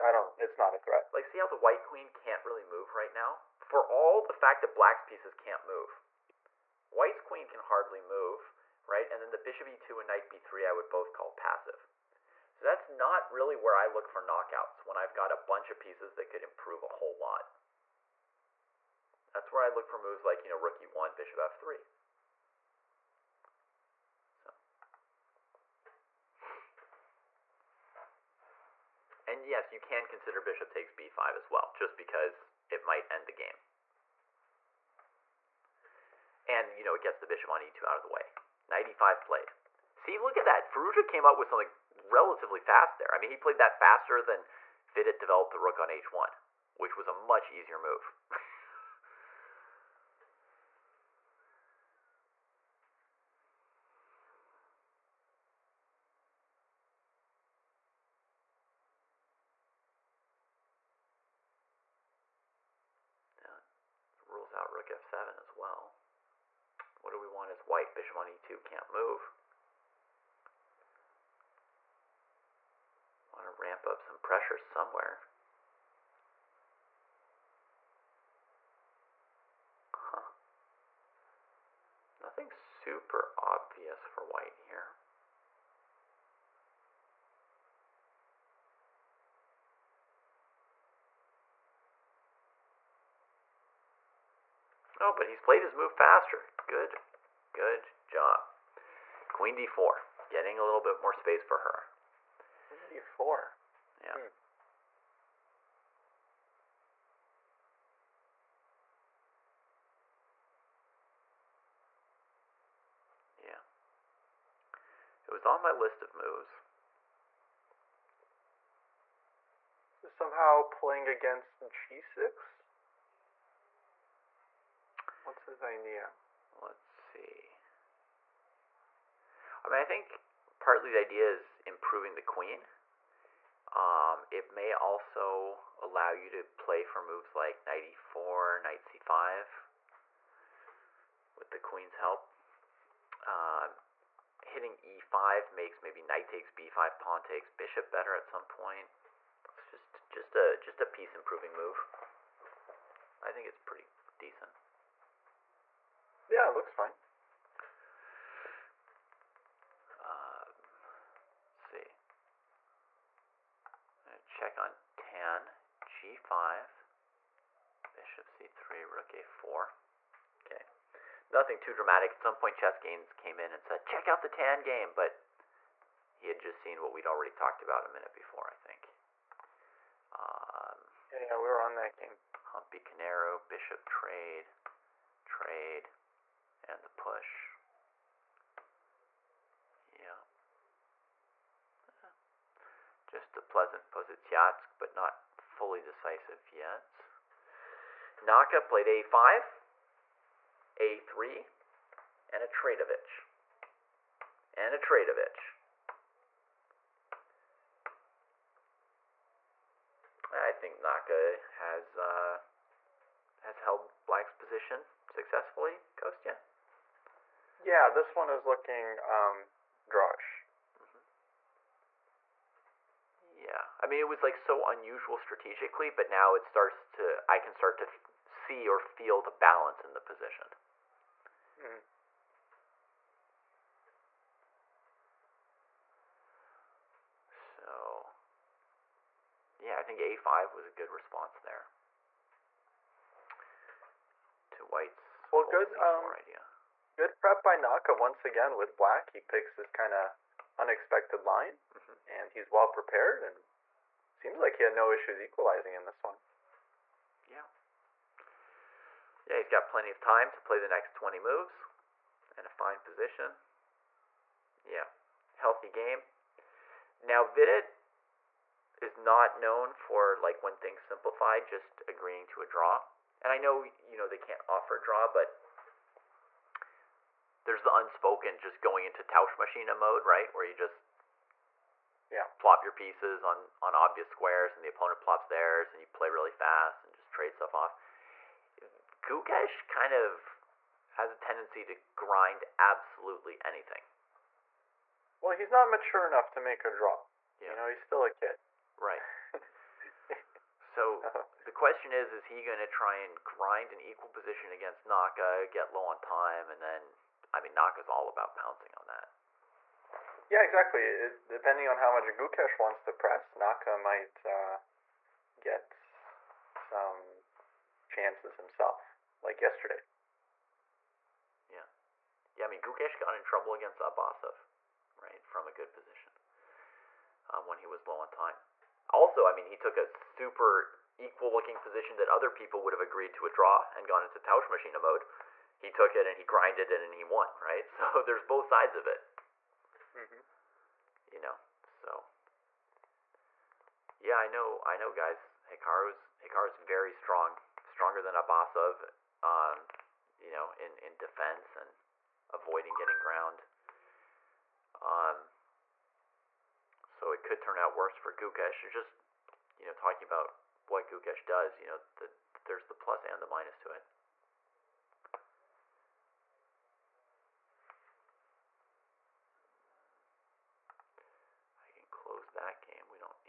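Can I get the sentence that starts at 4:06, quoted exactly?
Good prep by Naka once again with black.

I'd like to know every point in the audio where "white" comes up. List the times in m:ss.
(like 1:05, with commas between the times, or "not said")
0:01, 0:06, 1:07, 1:24, 4:04.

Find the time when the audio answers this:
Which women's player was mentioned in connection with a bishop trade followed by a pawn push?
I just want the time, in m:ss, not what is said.
3:02.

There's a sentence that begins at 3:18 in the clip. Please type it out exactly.
Naka played a5, a3, and a Tradovich.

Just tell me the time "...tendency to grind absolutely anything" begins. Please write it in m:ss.
4:51.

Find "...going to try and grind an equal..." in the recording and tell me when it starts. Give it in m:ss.
5:02.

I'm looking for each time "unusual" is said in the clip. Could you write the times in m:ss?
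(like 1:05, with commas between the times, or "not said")
3:44.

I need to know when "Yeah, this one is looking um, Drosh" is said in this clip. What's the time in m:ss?
3:37.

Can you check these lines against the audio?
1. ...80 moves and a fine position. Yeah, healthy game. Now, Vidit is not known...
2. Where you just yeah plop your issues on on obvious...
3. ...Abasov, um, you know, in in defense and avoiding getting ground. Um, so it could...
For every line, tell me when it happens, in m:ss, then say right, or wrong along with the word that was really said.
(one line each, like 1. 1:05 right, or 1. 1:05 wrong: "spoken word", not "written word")
1. 4:20 wrong: "20", not "80"
2. 4:40 wrong: "pieces", not "issues"
3. 5:48 right.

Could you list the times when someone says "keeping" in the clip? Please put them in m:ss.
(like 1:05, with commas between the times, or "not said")
not said.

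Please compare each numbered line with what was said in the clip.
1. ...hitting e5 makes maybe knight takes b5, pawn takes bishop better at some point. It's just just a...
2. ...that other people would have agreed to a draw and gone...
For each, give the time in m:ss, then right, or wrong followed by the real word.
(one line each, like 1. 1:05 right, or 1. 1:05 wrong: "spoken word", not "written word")
1. 2:24 right
2. 5:31 right.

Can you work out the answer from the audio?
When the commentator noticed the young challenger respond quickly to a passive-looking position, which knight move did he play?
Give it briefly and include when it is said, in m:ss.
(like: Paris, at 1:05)
Knight e5, at 0:38.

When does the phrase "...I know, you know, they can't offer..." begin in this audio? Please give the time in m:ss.
4:33.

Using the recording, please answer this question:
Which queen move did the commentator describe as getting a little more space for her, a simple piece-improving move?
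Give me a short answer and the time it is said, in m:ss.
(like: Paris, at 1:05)
Queen d4, at 1:39.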